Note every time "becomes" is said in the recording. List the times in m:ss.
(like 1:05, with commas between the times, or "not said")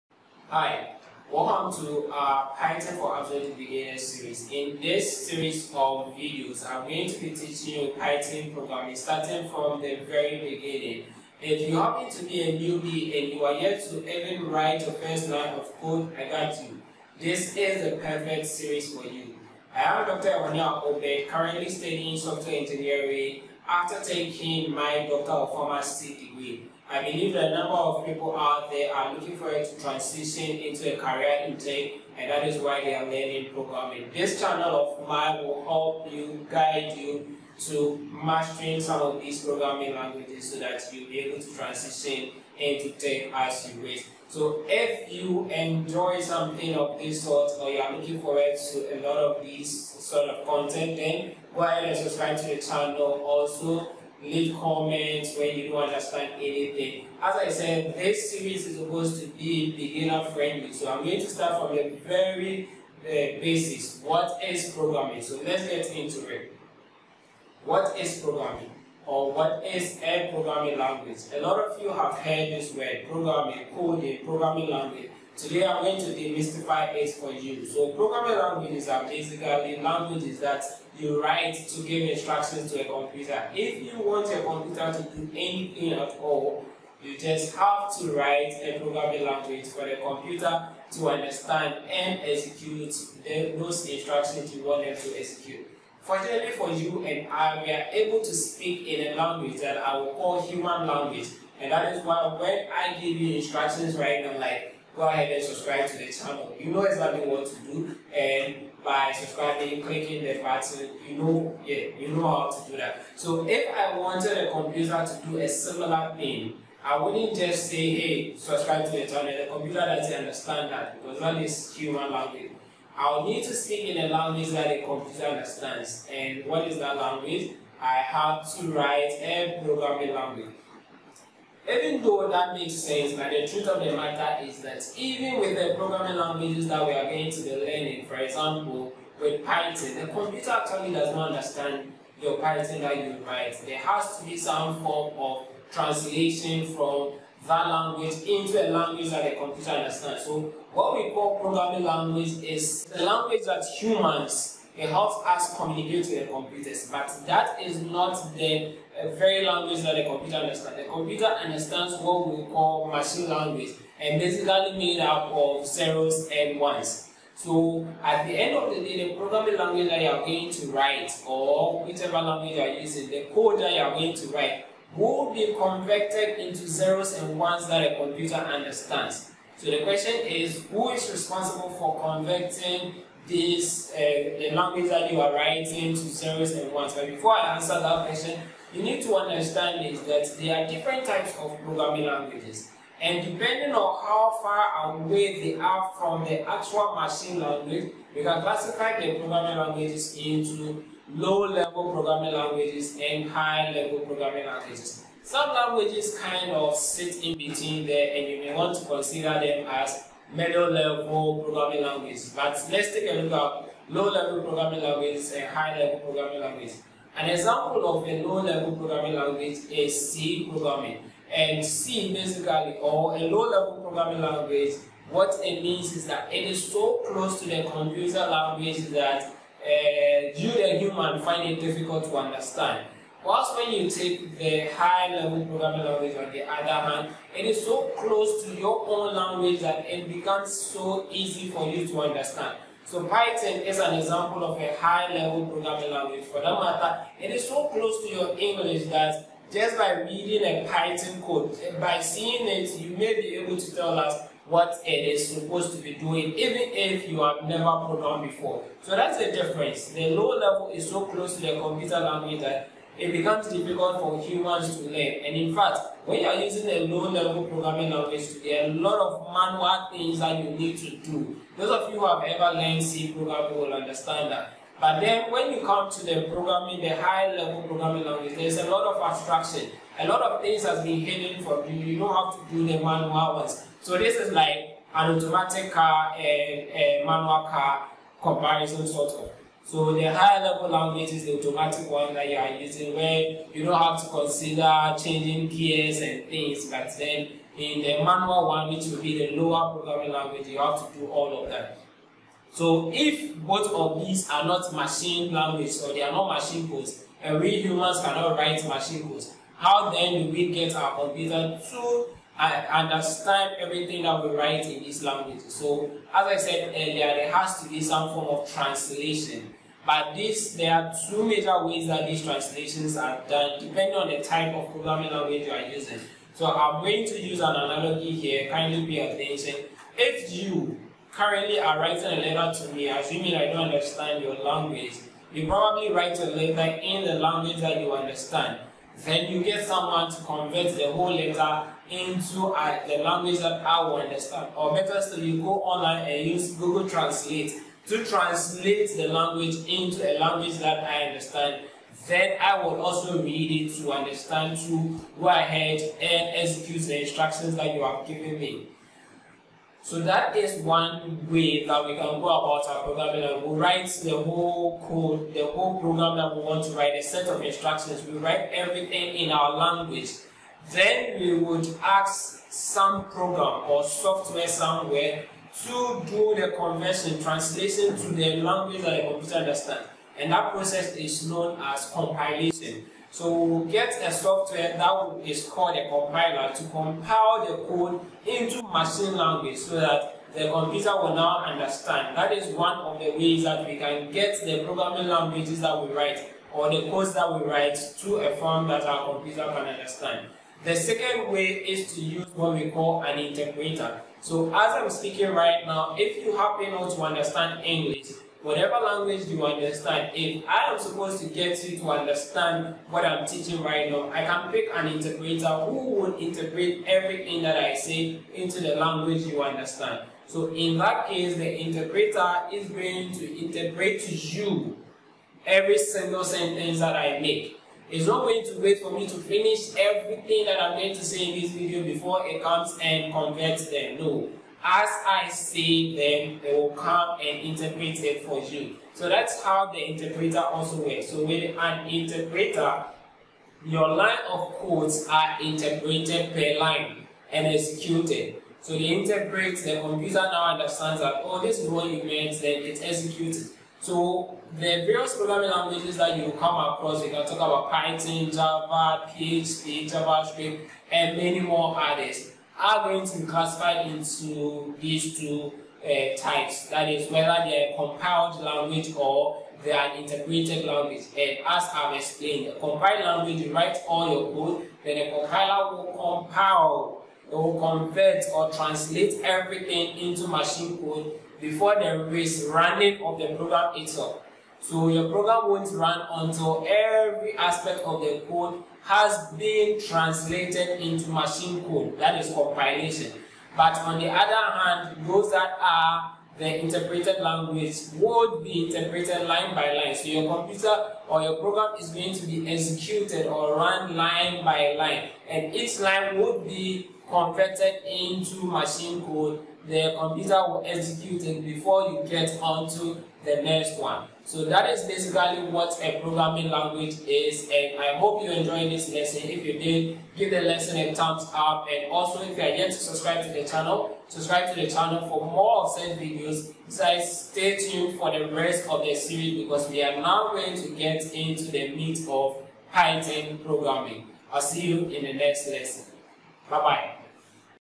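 4:00, 4:23.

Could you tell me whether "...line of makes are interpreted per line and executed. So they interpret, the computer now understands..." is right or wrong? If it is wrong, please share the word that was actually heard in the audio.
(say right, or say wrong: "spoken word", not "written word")
wrong: "codes", not "makes".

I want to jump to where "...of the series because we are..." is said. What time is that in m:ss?
8:48.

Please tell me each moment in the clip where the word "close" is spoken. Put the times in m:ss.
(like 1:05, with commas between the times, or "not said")
3:47, 3:57, 4:07, 4:21.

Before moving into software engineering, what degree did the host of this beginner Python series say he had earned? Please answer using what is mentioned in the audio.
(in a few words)
Doctor of Pharmacy.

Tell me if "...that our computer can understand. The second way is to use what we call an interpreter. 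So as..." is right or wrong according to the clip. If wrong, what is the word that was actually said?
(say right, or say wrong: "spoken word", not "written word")
right.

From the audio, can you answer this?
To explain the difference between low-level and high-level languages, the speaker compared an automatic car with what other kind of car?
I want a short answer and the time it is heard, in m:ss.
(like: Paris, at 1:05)
A manual car, at 4:46.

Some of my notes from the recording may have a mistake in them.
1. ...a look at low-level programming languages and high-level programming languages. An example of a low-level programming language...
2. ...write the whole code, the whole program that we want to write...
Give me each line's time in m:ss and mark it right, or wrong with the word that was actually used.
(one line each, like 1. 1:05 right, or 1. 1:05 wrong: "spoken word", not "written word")
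1. 3:33 right
2. 6:03 right.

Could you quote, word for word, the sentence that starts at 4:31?
Those of you who have ever learned C programming will understand that.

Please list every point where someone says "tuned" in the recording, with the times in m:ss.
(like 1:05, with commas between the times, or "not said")
8:47.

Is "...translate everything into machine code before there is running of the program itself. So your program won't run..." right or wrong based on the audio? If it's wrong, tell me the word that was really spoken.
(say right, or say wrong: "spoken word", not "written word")
right.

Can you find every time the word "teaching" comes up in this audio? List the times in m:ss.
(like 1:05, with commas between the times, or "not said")
0:07, 6:53.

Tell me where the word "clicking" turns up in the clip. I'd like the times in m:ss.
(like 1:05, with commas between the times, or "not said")
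1:49.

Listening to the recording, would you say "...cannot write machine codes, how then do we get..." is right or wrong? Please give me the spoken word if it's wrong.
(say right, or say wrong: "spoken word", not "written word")
right.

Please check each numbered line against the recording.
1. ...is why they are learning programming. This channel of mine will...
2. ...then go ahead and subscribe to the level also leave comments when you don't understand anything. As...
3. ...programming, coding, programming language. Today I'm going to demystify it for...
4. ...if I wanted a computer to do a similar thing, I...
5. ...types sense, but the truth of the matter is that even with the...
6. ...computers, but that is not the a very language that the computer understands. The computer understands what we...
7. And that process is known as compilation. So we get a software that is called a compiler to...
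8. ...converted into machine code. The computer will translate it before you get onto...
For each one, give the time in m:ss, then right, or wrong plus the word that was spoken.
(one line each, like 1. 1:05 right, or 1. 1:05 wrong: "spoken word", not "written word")
1. 0:32 right
2. 0:50 wrong: "channel", not "level"
3. 1:13 right
4. 1:53 right
5. 2:12 wrong: "makes", not "types"
6. 2:36 right
7. 6:20 right
8. 8:27 wrong: "execute", not "translate".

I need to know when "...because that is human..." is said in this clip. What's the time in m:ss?
2:01.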